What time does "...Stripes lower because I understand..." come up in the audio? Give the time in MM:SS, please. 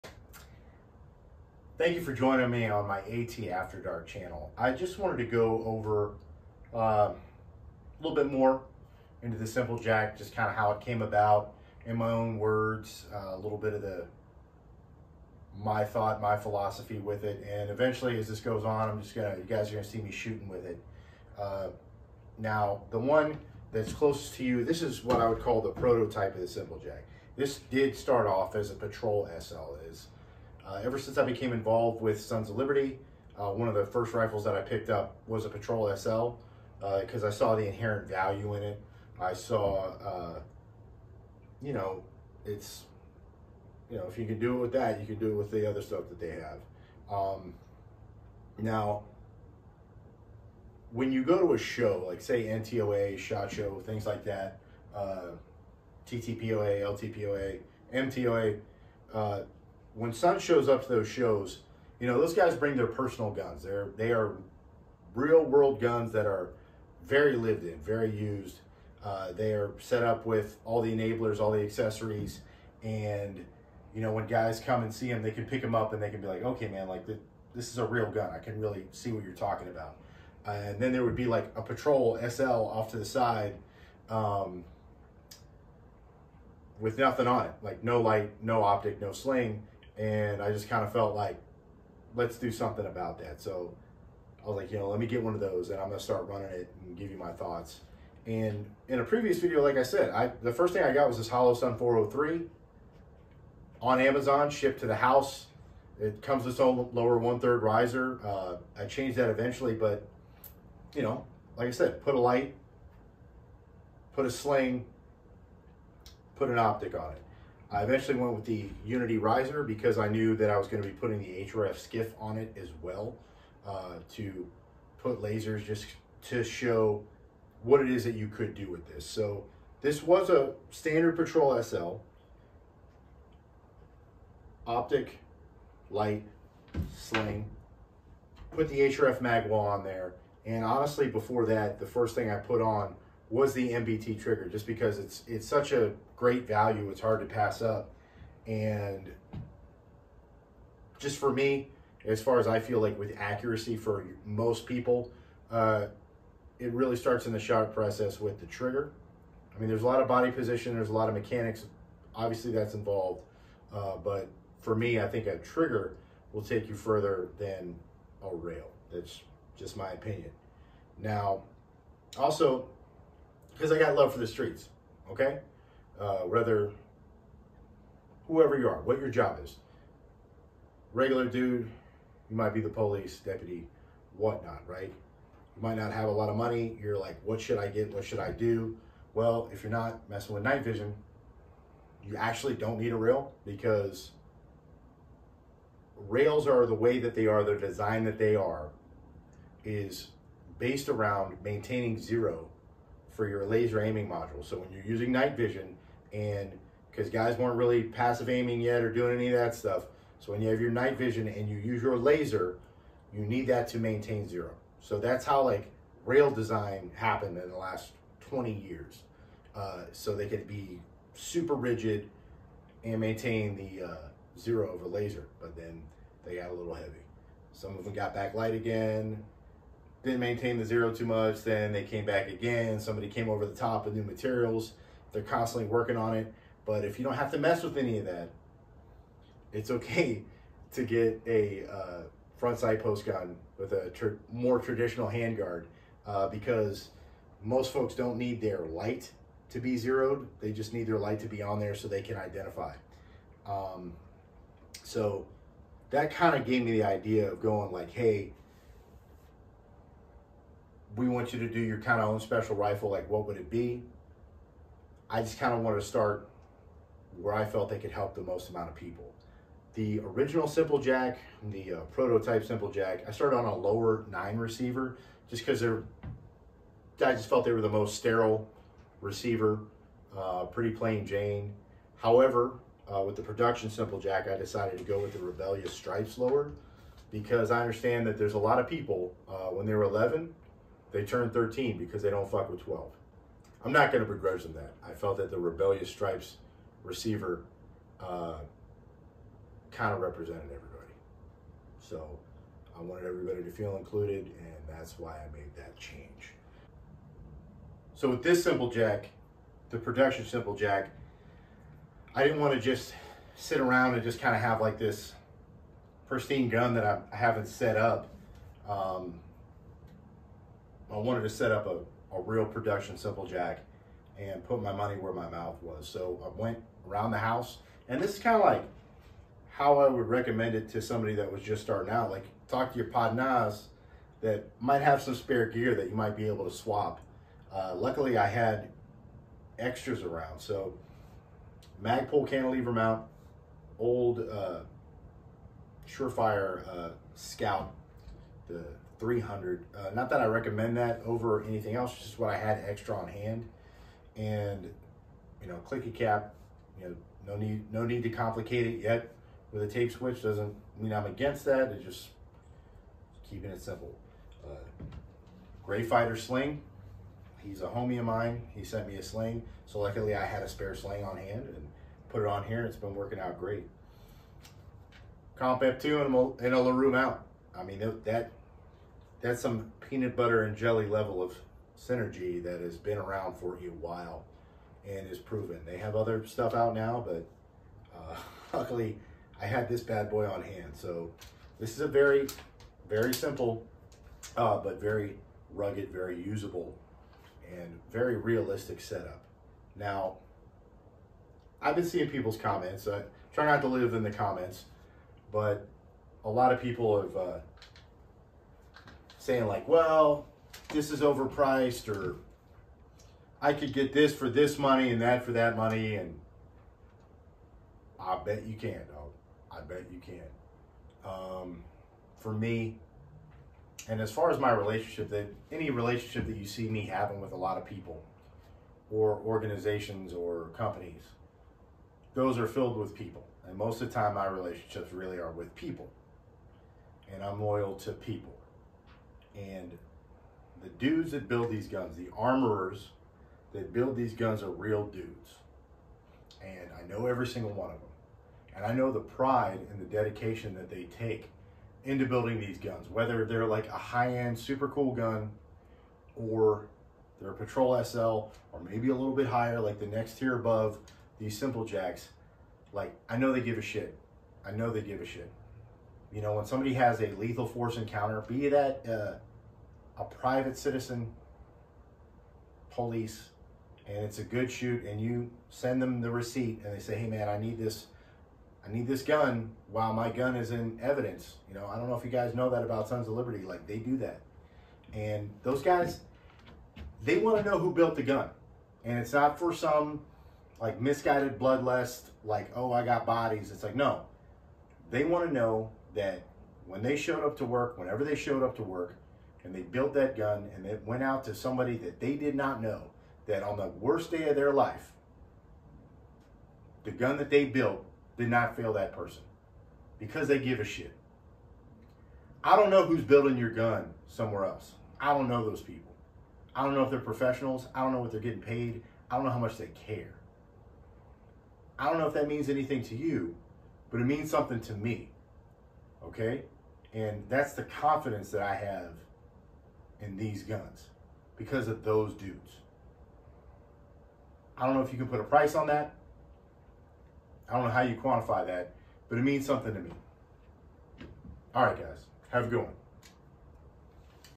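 04:45.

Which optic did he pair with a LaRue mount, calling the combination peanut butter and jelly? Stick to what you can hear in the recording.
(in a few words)
Comp F2.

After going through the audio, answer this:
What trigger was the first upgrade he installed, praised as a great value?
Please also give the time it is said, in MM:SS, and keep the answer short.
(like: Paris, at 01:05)
MBT trigger, at 02:23.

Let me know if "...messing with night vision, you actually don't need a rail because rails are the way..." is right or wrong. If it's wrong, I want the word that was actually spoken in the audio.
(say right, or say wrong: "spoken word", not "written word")
right.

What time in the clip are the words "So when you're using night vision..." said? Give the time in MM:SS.
03:24.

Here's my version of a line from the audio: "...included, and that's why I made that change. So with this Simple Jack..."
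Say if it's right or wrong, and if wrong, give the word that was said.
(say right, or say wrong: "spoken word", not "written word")
right.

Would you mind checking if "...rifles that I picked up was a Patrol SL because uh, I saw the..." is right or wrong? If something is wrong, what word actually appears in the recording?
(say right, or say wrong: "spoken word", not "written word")
right.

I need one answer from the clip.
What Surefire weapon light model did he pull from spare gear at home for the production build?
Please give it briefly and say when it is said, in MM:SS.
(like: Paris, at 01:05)
Scout 300, at 05:47.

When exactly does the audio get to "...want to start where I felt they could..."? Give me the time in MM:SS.
04:25.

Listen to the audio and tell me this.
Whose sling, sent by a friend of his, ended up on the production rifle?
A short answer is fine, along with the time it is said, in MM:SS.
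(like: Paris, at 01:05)
Gray Fighter, at 06:05.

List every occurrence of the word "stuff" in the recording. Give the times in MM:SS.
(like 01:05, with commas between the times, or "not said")
00:45, 03:29, 06:26.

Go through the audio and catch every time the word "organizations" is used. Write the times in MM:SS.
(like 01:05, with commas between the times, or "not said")
07:09.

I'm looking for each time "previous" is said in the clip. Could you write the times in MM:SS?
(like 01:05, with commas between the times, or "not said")
01:39.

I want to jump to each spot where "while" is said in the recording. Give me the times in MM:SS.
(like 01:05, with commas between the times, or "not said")
06:23, 07:59.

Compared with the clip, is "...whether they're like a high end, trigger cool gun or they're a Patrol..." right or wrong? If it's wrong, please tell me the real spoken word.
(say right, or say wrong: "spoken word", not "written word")
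wrong: "super", not "trigger".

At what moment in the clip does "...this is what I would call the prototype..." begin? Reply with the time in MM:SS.
00:24.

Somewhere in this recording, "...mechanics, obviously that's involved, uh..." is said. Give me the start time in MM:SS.
02:41.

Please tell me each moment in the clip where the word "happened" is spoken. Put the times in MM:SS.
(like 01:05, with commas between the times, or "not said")
03:36.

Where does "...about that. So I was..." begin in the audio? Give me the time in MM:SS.
01:32.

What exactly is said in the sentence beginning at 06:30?
So this is a very, very simple, uh, but very rugged, very usable, and very realistic setup.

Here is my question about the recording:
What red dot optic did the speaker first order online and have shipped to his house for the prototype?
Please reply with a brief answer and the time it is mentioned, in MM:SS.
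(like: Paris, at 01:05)
Holosun 403, at 01:41.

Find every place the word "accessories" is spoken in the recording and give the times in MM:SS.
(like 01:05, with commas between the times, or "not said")
01:11.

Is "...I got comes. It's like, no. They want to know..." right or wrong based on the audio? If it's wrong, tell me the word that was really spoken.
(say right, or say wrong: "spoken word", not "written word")
wrong: "bodies", not "comes".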